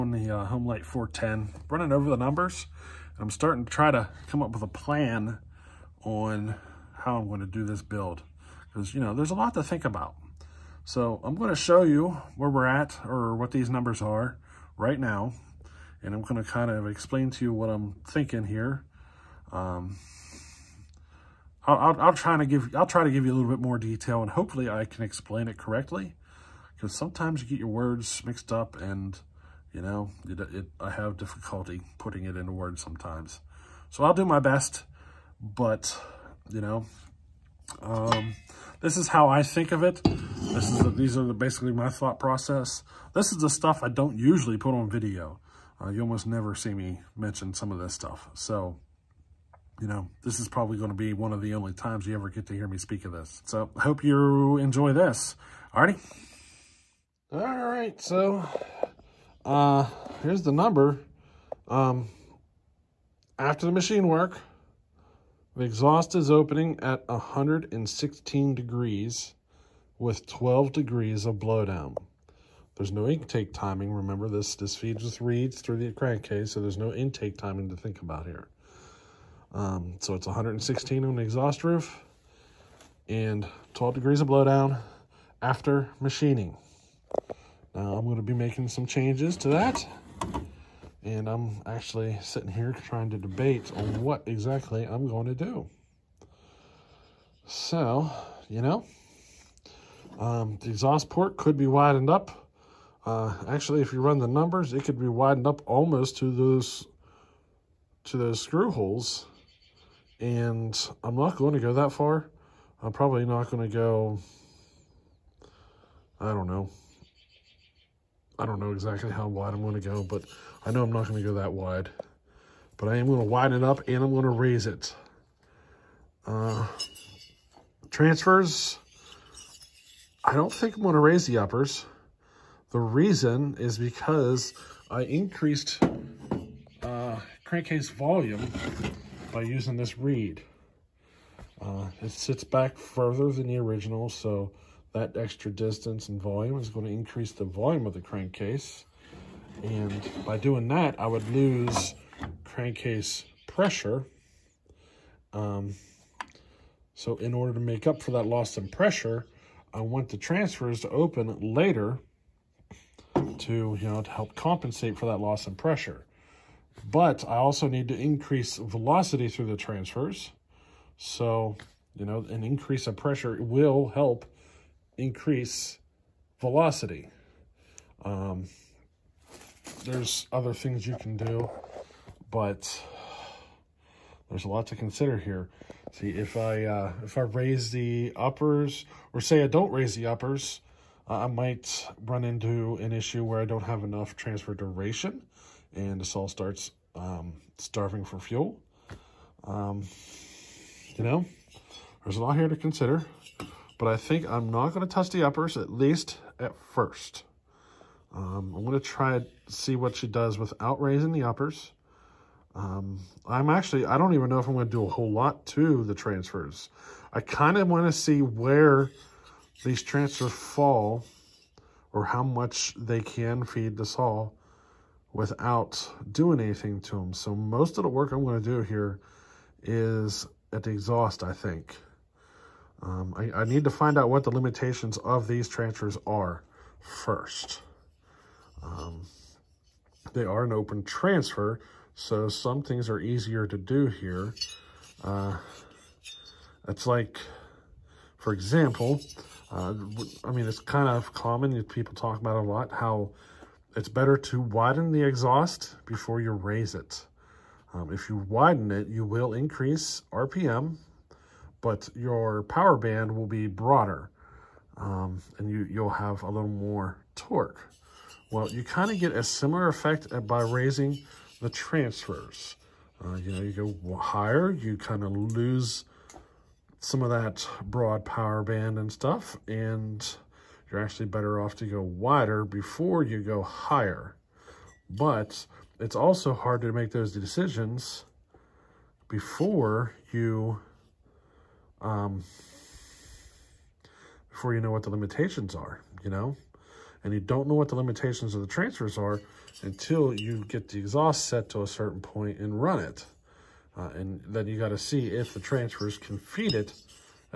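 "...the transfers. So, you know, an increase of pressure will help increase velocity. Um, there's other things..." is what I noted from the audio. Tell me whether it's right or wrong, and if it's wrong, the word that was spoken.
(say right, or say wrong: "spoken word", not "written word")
right.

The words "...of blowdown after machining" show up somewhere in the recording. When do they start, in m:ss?
1:24.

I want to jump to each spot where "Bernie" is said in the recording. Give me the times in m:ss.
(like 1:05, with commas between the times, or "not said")
not said.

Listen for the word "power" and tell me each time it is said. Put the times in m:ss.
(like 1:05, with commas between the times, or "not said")
4:22, 4:38.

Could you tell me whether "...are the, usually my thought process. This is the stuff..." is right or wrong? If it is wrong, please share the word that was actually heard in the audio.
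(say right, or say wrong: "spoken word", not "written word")
wrong: "basically", not "usually".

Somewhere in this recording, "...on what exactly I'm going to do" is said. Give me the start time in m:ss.
1:33.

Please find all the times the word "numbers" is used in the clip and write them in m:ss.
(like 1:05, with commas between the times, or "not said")
0:02, 0:13, 1:00, 1:44.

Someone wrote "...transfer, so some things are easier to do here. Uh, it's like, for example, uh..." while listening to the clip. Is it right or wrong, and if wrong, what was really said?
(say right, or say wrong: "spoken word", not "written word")
right.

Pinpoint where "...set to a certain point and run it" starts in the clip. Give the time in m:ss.
5:01.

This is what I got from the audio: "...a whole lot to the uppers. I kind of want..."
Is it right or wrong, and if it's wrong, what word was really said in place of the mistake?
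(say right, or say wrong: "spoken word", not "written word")
wrong: "transfers", not "uppers".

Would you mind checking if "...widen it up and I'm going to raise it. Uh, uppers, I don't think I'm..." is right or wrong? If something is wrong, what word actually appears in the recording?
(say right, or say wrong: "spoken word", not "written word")
wrong: "transfers", not "uppers".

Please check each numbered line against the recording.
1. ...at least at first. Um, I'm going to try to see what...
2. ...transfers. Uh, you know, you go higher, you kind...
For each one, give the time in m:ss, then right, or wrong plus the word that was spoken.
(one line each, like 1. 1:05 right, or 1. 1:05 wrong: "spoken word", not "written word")
1. 3:25 right
2. 4:31 right.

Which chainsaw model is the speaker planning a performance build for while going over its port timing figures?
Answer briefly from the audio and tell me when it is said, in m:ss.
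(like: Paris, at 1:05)
Homelite 410, at 0:00.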